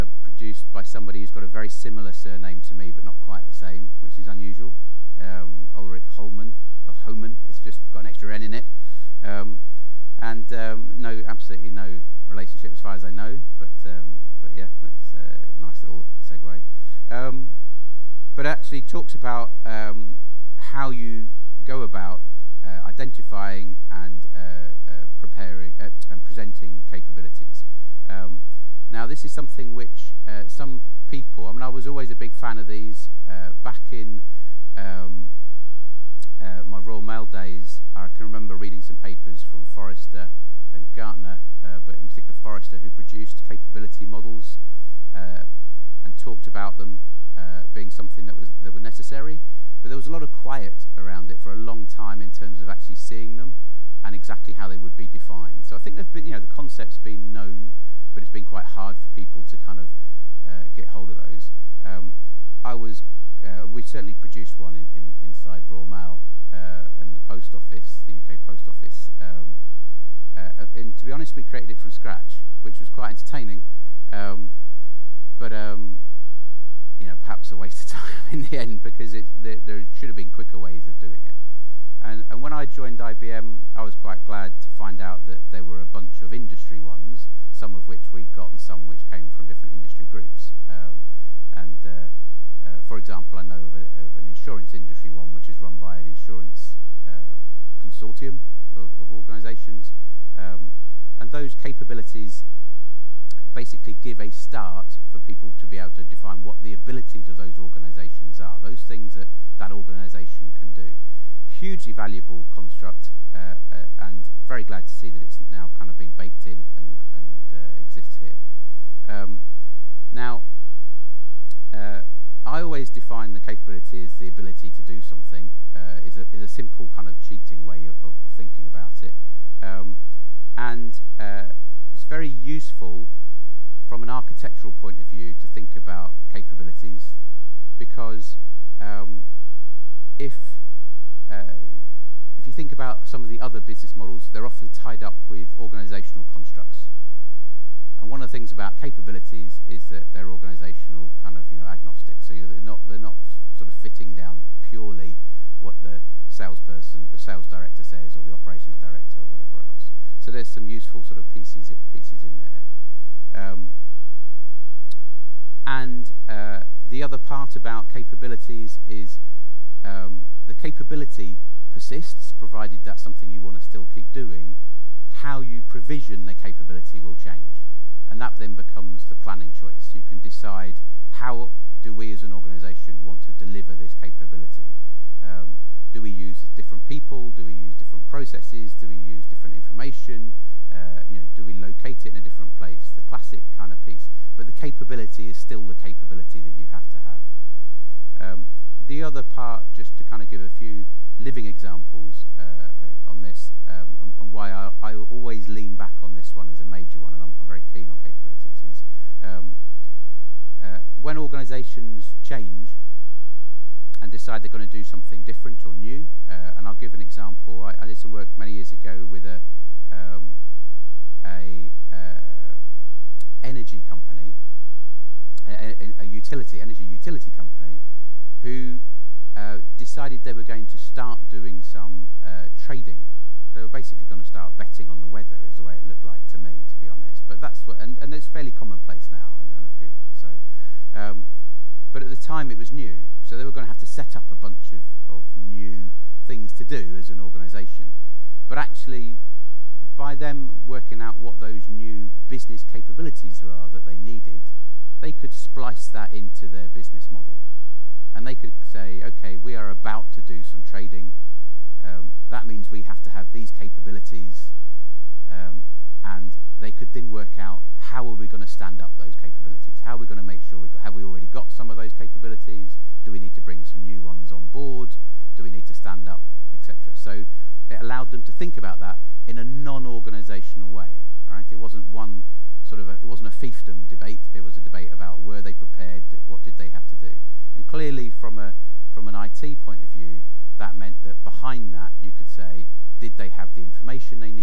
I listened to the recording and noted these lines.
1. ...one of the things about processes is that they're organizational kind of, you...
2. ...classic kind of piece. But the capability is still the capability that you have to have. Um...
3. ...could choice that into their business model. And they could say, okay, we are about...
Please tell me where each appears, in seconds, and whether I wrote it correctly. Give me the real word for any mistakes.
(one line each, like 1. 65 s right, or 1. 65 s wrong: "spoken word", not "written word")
1. 148 s wrong: "capabilities", not "processes"
2. 193 s right
3. 255 s wrong: "splice", not "choice".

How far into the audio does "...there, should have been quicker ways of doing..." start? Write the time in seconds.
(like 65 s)
79 s.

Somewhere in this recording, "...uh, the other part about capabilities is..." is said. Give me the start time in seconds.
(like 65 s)
166 s.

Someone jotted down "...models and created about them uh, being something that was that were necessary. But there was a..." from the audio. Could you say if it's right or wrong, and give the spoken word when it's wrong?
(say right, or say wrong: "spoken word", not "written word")
wrong: "talked", not "created".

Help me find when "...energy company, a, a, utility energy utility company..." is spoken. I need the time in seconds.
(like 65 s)
223 s.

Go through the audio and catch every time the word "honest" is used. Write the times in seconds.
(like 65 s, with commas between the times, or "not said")
71 s, 236 s.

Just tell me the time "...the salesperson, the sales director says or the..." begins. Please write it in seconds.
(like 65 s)
155 s.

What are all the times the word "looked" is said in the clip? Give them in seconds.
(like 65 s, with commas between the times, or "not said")
235 s.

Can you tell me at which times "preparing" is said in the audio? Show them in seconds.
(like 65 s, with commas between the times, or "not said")
25 s.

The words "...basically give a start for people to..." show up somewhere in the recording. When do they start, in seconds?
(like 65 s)
103 s.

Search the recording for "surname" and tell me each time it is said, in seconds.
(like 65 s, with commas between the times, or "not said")
2 s.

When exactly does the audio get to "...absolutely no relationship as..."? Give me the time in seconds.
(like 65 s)
11 s.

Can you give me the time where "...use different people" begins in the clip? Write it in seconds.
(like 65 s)
186 s.